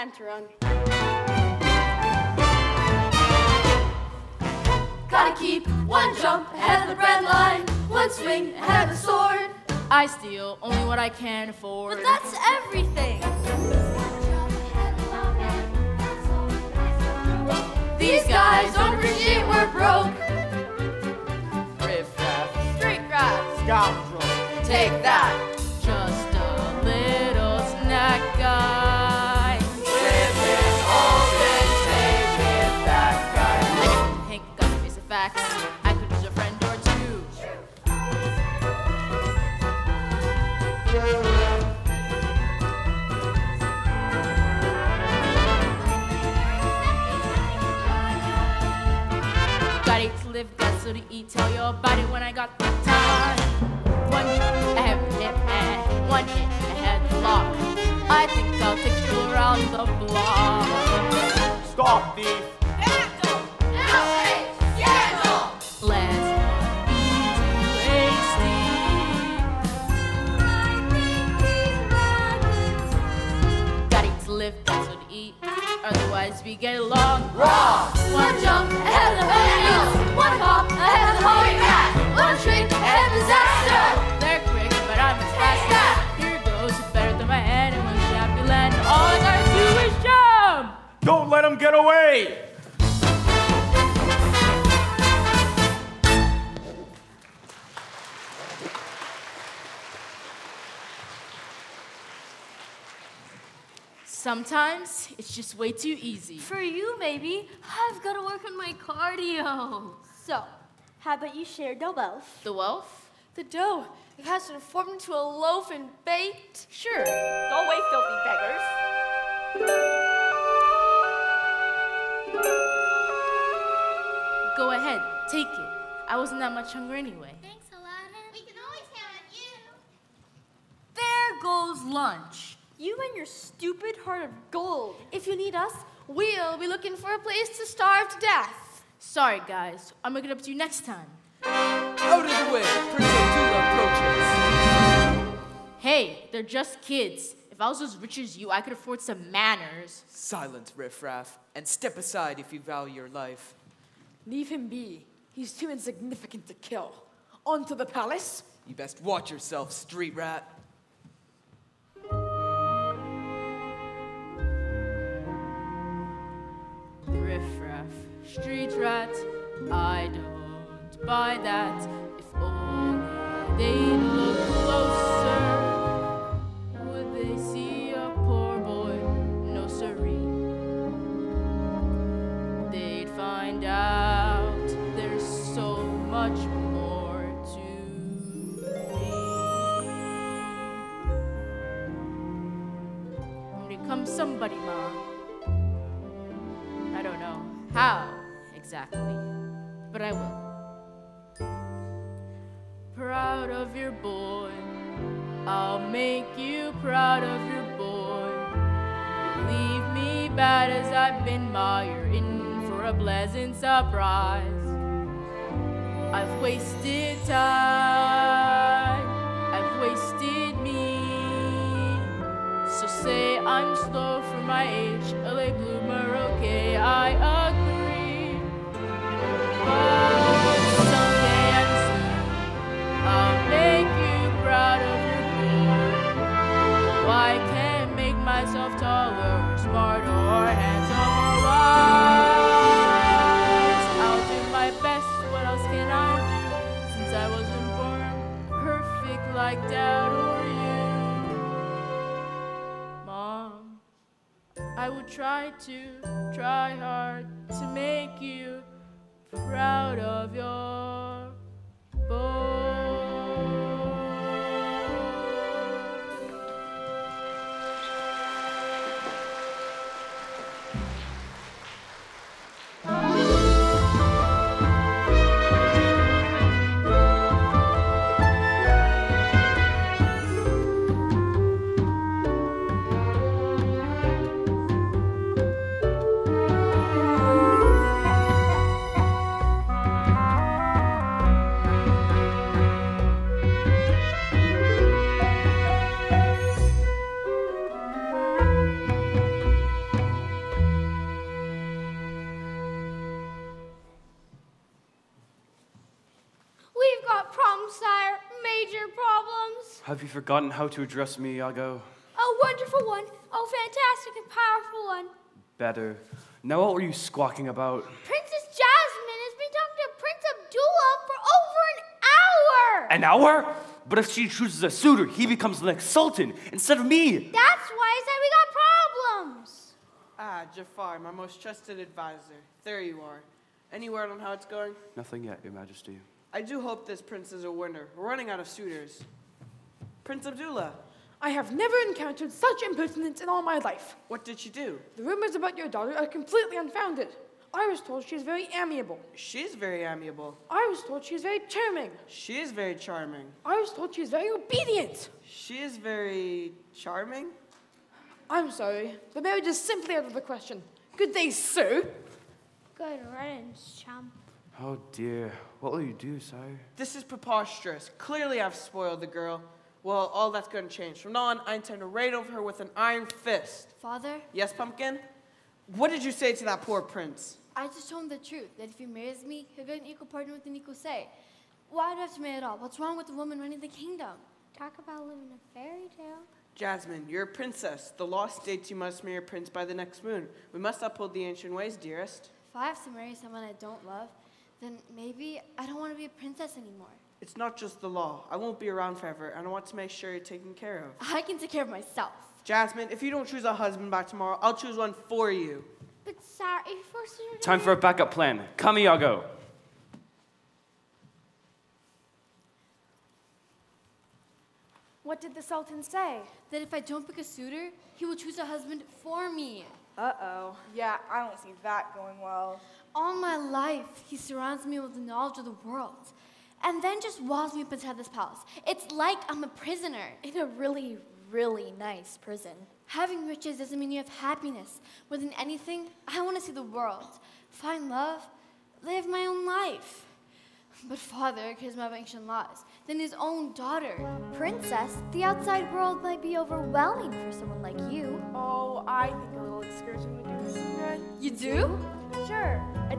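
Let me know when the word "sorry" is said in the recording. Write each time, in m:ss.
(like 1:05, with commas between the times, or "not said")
2:18, 5:58, 6:46.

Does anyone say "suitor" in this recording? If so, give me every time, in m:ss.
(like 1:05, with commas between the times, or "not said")
5:24, 5:38, 6:57.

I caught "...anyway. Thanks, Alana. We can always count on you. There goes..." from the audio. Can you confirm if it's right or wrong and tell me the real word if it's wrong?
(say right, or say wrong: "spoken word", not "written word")
right.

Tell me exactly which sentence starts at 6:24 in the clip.
Talk about living a fairy tale.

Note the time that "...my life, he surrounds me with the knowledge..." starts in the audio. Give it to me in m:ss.
7:03.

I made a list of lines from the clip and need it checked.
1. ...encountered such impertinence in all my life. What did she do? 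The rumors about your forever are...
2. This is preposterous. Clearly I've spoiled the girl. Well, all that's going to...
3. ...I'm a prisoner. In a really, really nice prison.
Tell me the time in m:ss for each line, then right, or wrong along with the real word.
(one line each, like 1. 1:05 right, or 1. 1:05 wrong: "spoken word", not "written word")
1. 5:41 wrong: "daughter", not "forever"
2. 6:06 right
3. 7:09 right.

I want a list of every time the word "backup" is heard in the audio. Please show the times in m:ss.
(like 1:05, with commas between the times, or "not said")
6:47.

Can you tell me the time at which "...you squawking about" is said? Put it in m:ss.
5:16.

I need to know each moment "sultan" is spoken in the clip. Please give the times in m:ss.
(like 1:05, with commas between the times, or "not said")
5:25, 6:55.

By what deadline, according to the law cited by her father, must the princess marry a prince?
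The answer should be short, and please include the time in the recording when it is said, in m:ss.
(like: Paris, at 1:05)
the next moon, at 6:29.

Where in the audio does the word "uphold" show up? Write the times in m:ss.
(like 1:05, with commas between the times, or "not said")
6:30.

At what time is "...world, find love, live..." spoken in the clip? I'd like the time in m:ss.
7:16.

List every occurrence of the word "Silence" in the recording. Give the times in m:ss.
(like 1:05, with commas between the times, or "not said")
2:30.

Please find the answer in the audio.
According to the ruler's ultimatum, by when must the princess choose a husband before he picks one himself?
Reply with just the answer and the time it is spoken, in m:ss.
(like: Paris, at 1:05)
tomorrow, at 6:43.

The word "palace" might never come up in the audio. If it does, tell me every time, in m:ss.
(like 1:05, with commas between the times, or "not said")
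2:37, 7:08.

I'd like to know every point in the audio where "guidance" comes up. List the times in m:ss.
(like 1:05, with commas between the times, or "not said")
not said.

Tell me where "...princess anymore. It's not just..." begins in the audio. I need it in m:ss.
6:36.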